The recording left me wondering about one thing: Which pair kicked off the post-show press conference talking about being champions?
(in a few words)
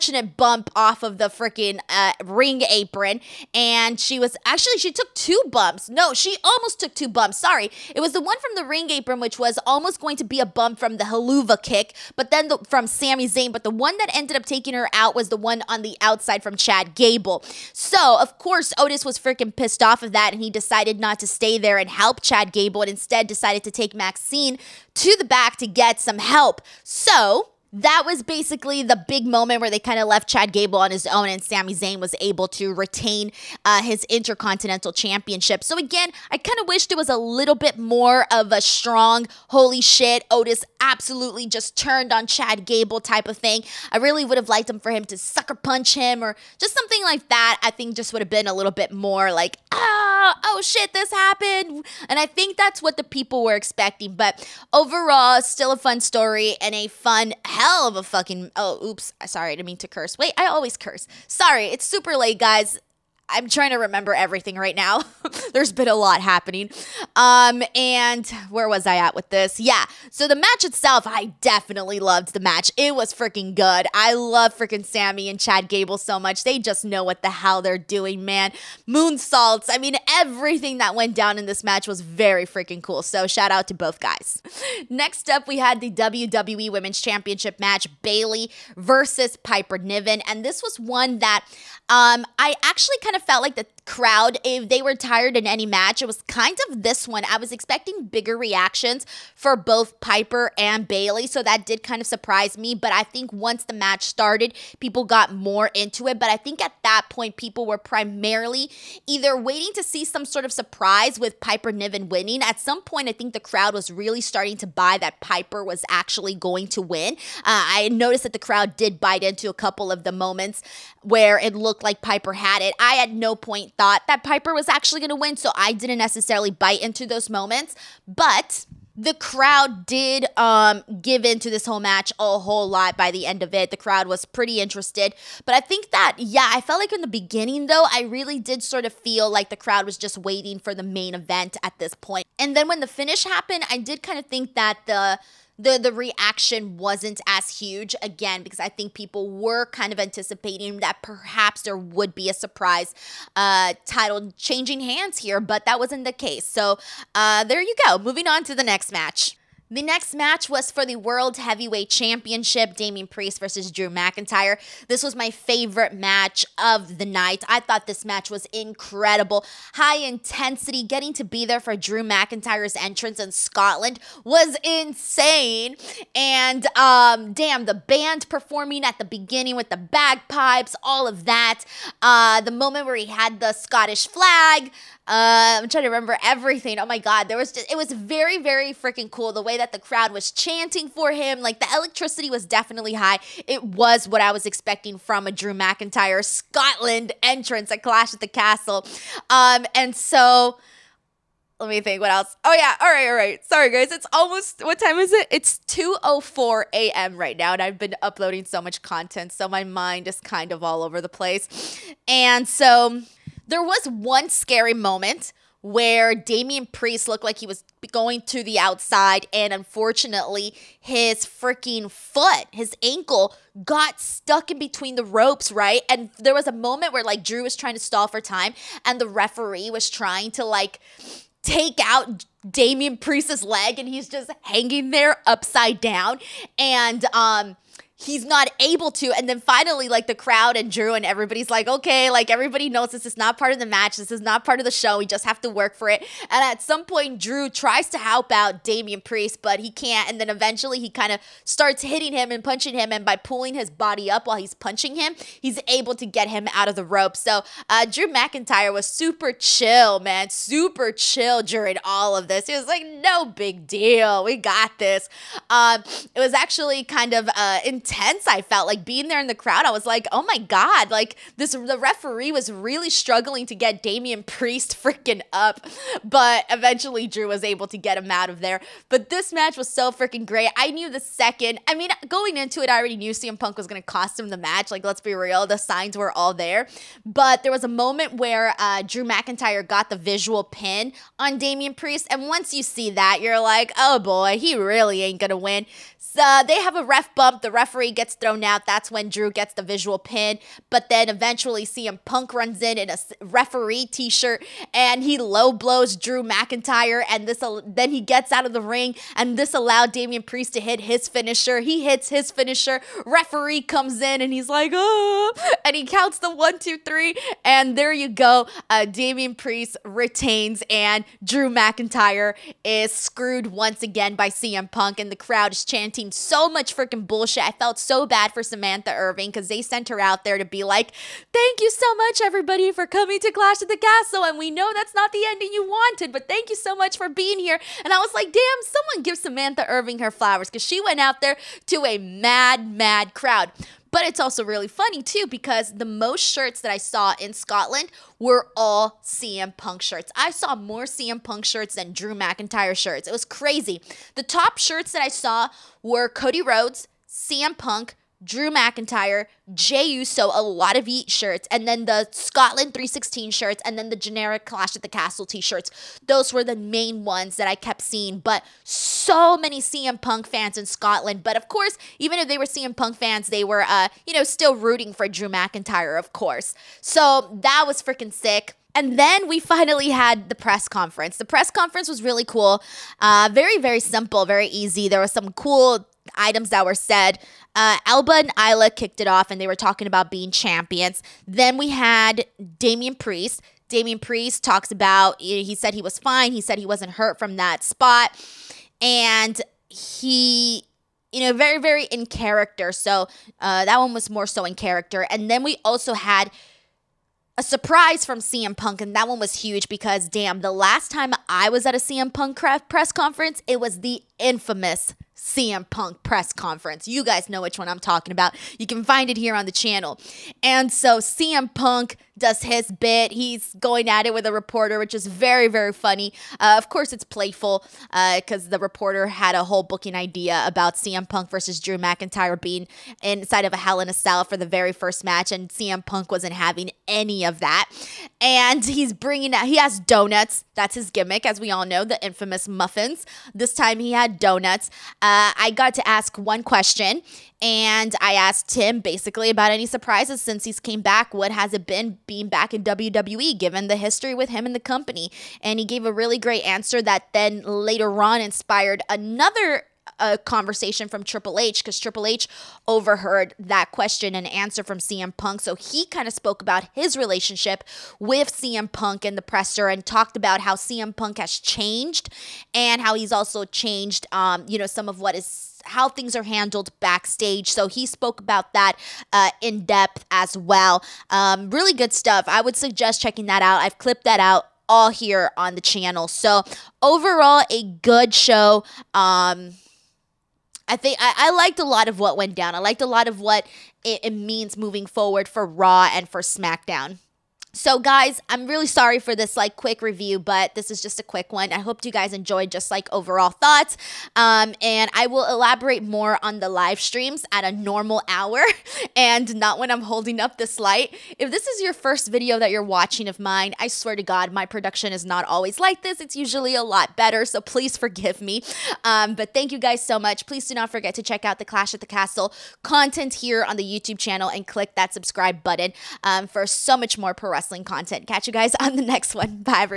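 Alba and Isla.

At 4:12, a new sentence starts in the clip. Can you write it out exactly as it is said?
And by pulling his body up while he's punching him, he's able to get him out of the rope.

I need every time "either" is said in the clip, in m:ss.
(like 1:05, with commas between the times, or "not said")
1:49.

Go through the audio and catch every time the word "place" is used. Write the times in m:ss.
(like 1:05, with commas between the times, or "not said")
3:31.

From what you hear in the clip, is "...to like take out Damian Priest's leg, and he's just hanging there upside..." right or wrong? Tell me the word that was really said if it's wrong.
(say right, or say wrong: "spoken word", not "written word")
right.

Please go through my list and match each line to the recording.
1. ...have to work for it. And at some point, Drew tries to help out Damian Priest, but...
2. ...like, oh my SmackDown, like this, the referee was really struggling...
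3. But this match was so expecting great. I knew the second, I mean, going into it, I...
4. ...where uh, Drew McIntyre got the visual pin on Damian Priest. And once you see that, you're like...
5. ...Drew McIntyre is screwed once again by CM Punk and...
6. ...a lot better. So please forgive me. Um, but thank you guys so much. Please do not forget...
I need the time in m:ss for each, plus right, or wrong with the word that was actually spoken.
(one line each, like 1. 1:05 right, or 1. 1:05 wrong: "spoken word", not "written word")
1. 4:05 right
2. 4:29 wrong: "God", not "SmackDown"
3. 4:38 wrong: "freaking", not "expecting"
4. 4:48 right
5. 5:21 right
6. 8:36 right.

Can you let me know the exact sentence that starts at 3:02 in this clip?
Uh, the moment where he had the Scottish flag, uh, I'm trying to remember everything.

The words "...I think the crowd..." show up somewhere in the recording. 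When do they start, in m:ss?
1:53.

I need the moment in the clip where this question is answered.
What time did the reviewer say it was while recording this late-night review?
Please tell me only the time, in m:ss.
3:25.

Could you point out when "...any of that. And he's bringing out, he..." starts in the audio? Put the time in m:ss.
7:16.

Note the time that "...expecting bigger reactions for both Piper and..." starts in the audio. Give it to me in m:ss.
1:37.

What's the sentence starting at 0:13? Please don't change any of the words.
But the one that ended up taking her out was the one on the outside from Chad Gable.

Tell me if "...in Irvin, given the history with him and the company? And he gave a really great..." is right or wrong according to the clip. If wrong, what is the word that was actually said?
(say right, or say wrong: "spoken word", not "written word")
wrong: "WWE", not "Irvin".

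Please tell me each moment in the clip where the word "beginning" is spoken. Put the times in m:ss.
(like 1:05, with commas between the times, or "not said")
2:17, 2:59.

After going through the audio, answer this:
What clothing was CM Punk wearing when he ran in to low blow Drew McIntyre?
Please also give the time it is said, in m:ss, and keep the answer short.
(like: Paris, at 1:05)
A referee t-shirt, at 5:03.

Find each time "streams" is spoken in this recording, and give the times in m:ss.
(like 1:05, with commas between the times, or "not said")
8:26.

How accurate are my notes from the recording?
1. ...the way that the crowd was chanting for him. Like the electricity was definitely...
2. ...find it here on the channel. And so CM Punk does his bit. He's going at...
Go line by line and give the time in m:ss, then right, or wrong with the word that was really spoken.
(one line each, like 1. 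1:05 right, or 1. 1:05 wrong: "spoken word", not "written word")
1. 3:09 right
2. 6:58 right.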